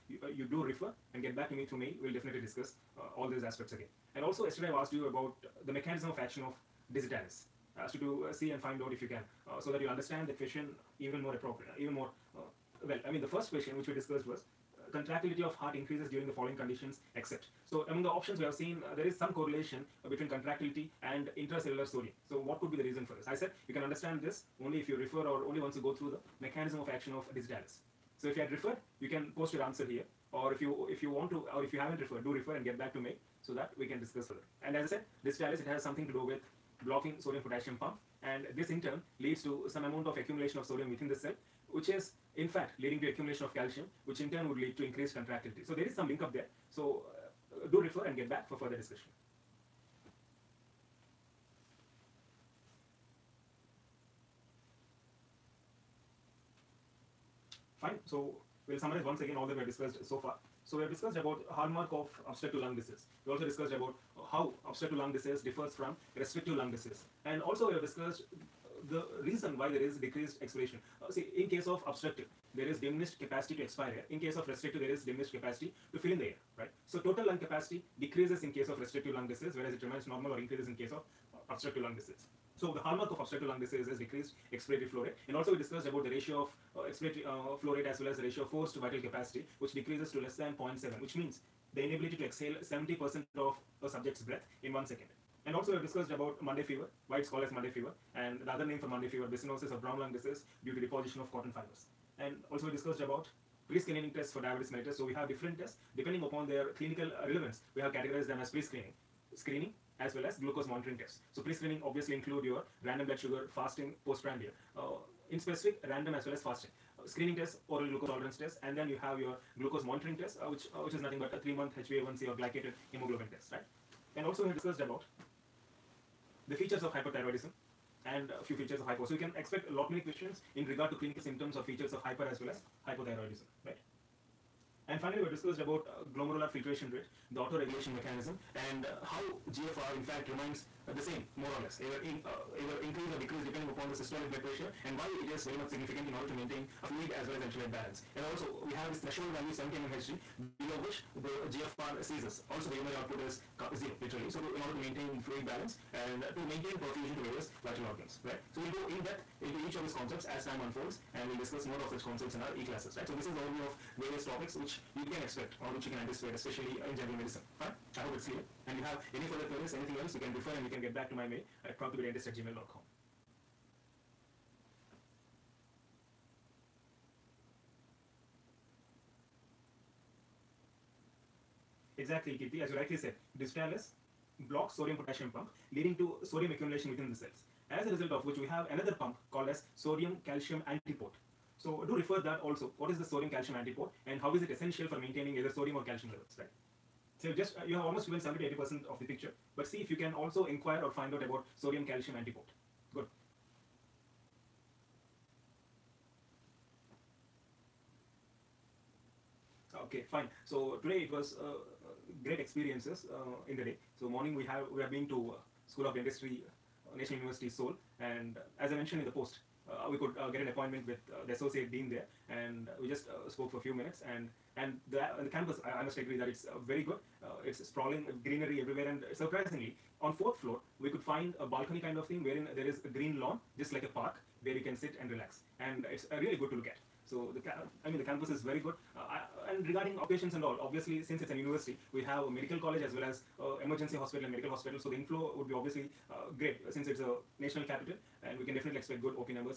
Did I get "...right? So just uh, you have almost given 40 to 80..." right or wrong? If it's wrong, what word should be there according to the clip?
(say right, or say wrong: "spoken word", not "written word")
wrong: "70", not "40".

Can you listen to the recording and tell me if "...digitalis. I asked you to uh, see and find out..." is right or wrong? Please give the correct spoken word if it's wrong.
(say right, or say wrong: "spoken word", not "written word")
right.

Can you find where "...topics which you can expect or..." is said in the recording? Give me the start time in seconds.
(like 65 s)
164 s.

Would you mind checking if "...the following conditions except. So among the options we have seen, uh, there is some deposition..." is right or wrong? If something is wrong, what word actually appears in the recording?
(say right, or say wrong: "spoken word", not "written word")
wrong: "correlation", not "deposition".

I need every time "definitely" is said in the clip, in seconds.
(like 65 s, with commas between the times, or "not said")
2 s, 248 s.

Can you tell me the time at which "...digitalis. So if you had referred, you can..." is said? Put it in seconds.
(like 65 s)
27 s.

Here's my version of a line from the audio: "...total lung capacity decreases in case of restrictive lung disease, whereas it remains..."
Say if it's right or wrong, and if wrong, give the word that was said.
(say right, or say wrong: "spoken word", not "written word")
right.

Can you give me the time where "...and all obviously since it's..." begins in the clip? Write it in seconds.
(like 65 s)
240 s.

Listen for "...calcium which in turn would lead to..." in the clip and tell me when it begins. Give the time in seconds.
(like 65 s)
43 s.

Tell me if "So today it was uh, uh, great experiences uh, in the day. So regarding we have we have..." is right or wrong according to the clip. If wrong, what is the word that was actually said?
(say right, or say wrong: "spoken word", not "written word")
wrong: "morning", not "regarding".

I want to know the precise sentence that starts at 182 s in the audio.
exactly Kirti, as you rightly said, digitalis blocks sodium potassium pump leading to sodium accumulation within the cells.